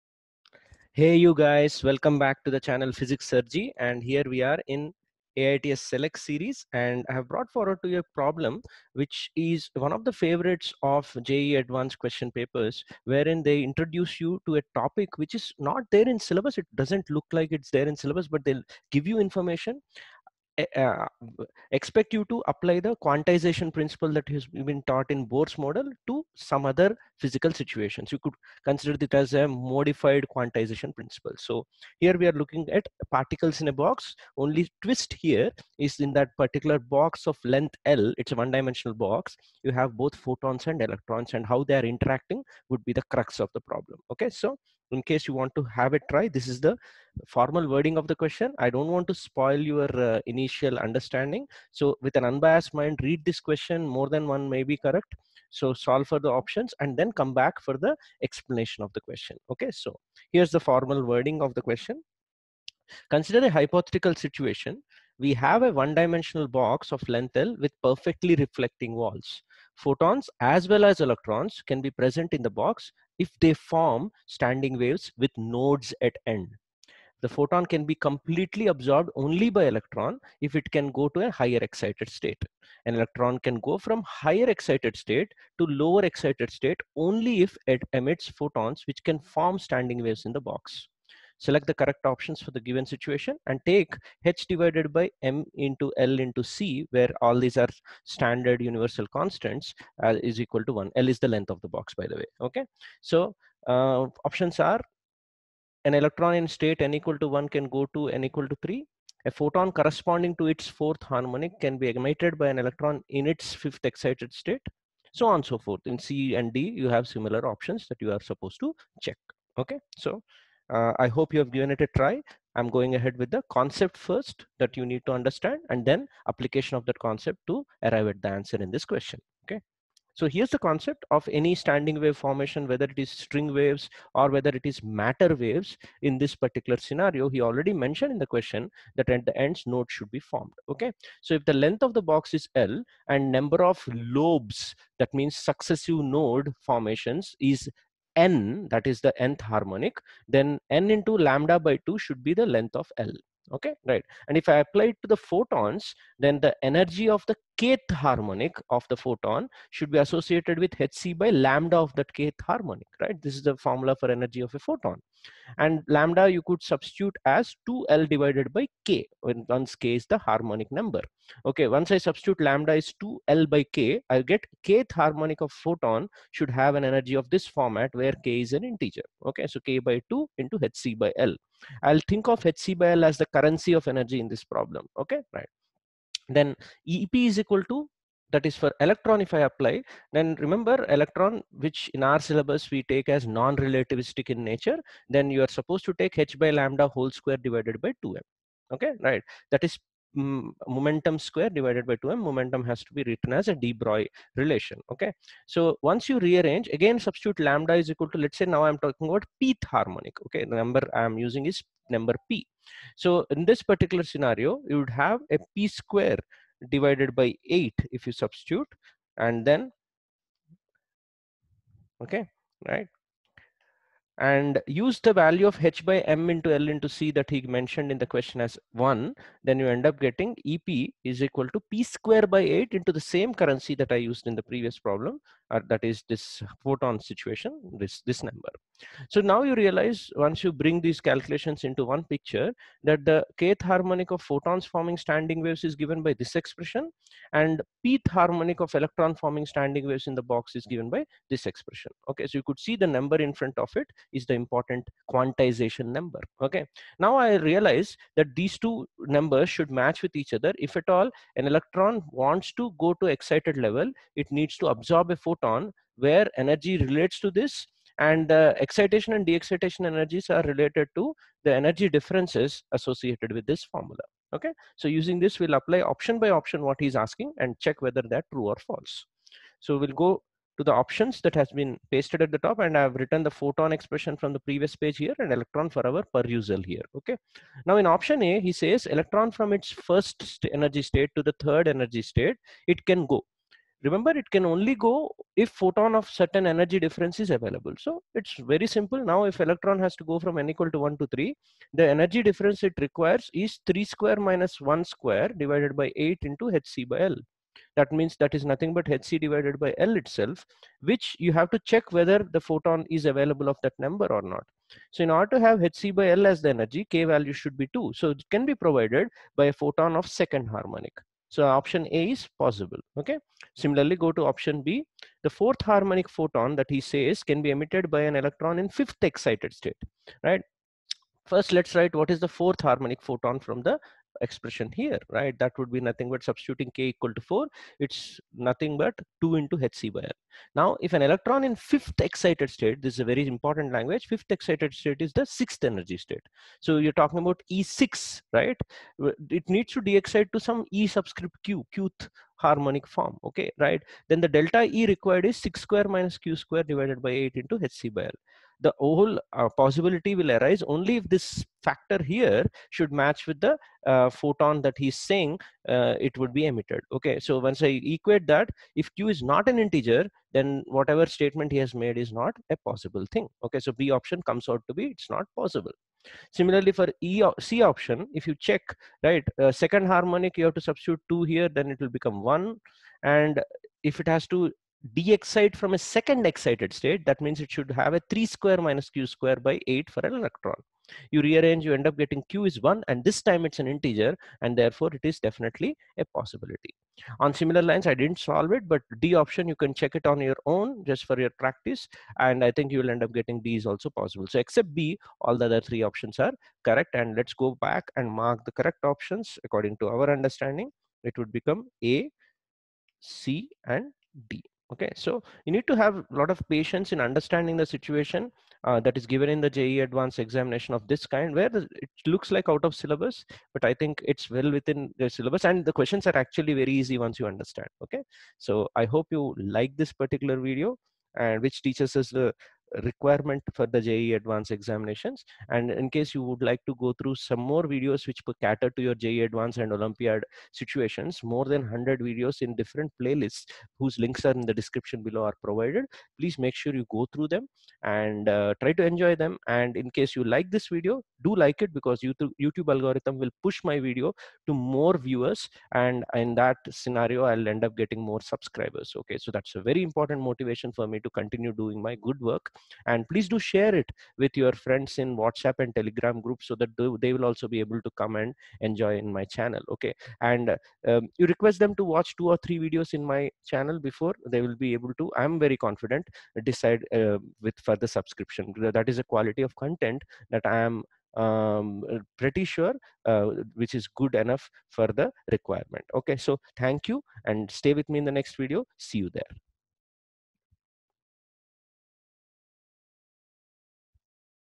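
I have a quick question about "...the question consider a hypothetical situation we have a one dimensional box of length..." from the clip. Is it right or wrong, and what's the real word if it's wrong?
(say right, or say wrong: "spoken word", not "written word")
right.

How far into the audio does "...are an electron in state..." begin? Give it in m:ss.
1:44.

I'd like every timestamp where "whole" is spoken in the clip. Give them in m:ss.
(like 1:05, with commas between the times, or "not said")
3:16, 5:58.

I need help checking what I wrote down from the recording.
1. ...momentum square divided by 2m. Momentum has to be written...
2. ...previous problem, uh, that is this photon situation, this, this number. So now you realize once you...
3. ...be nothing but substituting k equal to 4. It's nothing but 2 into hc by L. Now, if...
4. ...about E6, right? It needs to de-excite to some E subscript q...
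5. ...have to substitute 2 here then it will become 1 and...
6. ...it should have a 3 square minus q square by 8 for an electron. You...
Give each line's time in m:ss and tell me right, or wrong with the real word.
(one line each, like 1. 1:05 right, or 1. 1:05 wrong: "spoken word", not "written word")
1. 3:20 right
2. 3:54 right
3. 5:35 right
4. 5:47 right
5. 6:20 right
6. 6:27 right.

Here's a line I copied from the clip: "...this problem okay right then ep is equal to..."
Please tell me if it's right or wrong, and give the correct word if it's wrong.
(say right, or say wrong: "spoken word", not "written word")
right.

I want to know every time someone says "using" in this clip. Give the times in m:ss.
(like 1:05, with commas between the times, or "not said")
3:31, 4:34.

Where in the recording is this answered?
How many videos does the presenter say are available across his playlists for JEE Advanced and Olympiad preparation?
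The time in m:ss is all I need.
7:21.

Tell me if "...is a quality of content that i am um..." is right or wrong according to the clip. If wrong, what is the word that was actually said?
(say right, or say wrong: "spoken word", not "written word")
right.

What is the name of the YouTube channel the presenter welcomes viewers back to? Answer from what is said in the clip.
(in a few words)
Physics Sir JEE.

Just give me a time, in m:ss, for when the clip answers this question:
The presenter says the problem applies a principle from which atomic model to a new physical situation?
0:25.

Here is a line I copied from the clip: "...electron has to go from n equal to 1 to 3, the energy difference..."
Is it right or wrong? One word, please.
right.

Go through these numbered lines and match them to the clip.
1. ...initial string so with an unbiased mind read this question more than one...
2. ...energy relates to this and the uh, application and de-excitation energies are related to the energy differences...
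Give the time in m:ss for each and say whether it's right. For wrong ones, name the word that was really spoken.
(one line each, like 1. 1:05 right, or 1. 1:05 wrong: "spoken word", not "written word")
1. 0:50 wrong: "understanding", not "string"
2. 4:26 wrong: "excitation", not "application".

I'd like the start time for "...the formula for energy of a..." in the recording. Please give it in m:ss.
2:43.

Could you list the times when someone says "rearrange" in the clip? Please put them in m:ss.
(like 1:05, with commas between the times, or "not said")
3:26, 6:31.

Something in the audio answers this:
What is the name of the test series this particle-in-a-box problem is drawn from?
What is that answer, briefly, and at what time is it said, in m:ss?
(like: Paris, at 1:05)
AITS Select series, at 0:05.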